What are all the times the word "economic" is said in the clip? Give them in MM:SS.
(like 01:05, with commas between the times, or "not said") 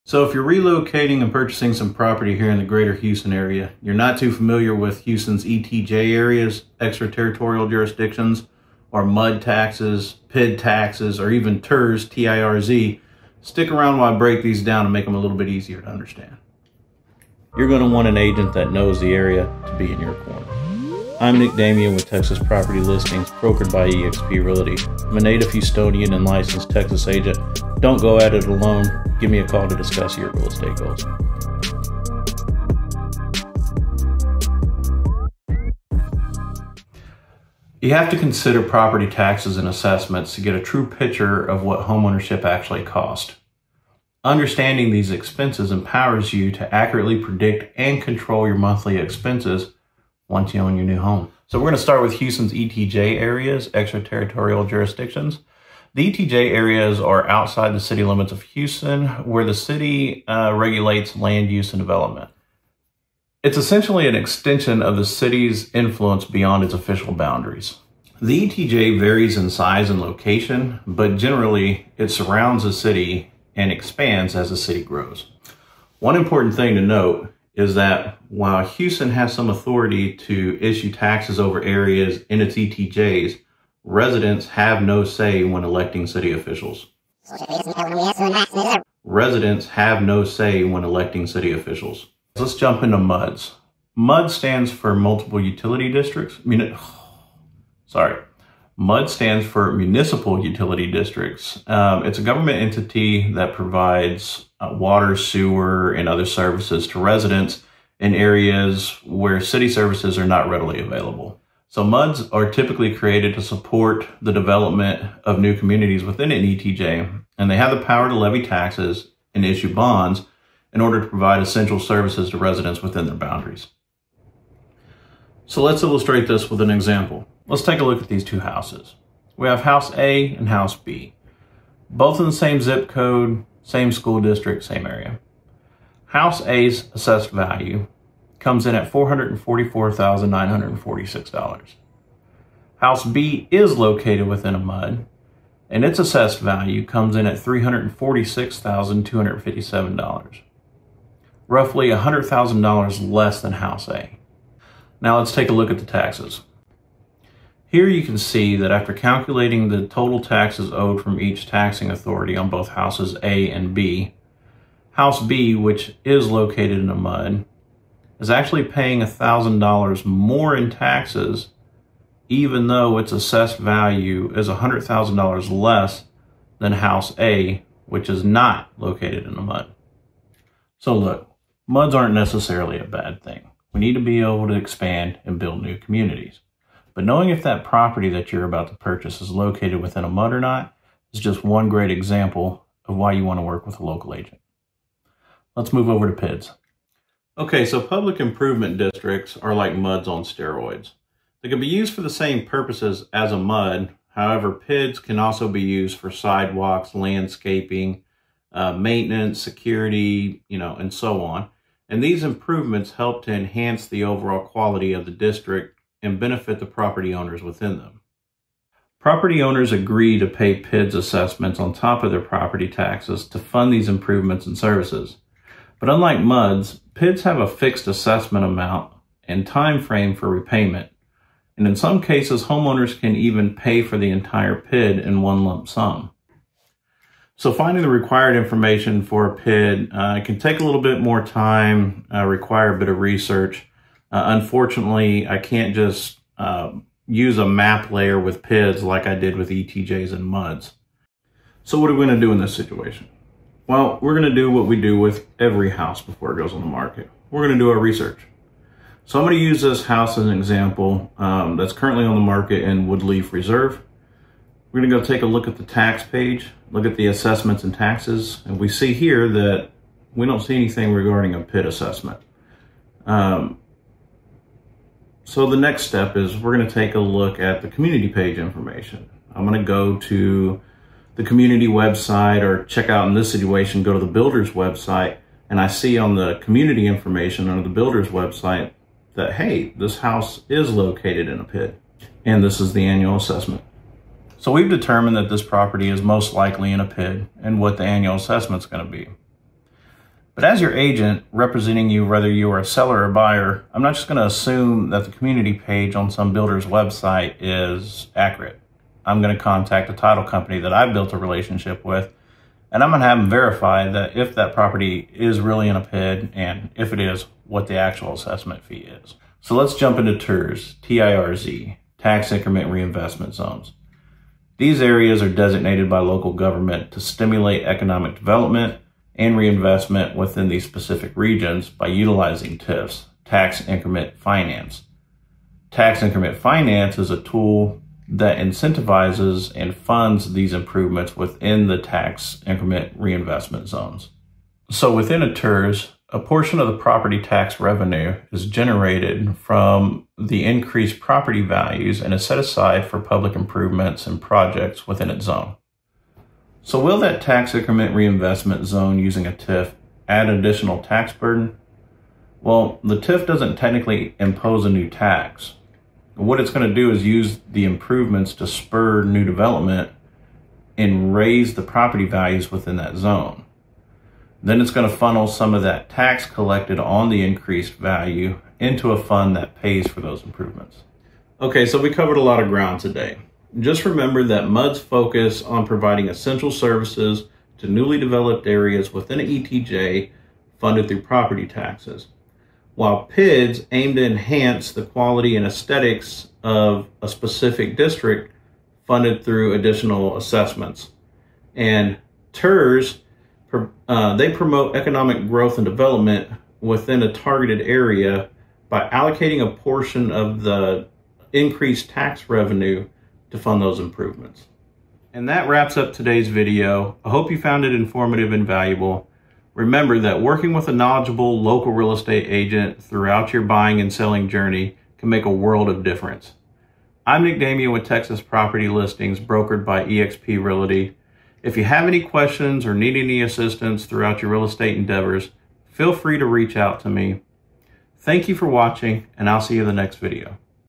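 05:27, 06:44.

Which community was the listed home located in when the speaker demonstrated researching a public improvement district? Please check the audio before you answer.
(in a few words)
Woodleaf Reserve.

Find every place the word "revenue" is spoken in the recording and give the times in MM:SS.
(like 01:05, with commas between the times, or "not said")
05:47, 06:52.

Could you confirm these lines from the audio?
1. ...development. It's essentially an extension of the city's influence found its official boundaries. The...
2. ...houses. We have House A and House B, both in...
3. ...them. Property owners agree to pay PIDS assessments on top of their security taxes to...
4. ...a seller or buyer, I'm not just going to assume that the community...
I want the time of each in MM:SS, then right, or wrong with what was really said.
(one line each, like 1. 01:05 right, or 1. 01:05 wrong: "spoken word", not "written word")
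1. 01:01 wrong: "beyond", not "found"
2. 02:08 right
3. 03:37 wrong: "property", not "security"
4. 05:02 right.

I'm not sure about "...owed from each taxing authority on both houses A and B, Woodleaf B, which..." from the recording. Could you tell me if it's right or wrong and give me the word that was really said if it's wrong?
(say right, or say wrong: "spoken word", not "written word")
wrong: "House", not "Woodleaf".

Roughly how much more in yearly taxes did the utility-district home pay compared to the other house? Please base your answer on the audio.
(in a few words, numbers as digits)
$1,000.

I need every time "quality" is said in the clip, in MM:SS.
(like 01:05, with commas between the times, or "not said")
03:34, 06:34.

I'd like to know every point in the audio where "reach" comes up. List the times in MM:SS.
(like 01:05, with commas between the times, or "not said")
07:16.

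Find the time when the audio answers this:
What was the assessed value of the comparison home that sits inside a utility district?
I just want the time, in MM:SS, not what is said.
02:27.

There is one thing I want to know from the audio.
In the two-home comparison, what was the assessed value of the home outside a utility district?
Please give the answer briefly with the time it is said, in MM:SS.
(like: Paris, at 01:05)
$444,946, at 02:18.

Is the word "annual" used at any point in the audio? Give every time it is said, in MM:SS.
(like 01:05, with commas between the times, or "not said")
04:52, 04:57.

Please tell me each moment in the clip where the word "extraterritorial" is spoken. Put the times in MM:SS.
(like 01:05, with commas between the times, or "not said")
00:06, 00:53.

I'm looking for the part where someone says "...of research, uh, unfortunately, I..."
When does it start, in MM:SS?
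04:02.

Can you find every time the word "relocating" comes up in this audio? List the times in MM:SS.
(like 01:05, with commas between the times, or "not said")
00:00.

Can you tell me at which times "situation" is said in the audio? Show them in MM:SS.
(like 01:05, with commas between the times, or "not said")
04:12, 04:43.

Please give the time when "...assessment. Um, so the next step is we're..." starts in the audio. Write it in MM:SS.
04:31.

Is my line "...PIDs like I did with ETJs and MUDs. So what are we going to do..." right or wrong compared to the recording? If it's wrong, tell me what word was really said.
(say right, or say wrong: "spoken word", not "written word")
right.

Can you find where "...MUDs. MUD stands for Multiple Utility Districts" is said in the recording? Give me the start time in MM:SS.
01:32.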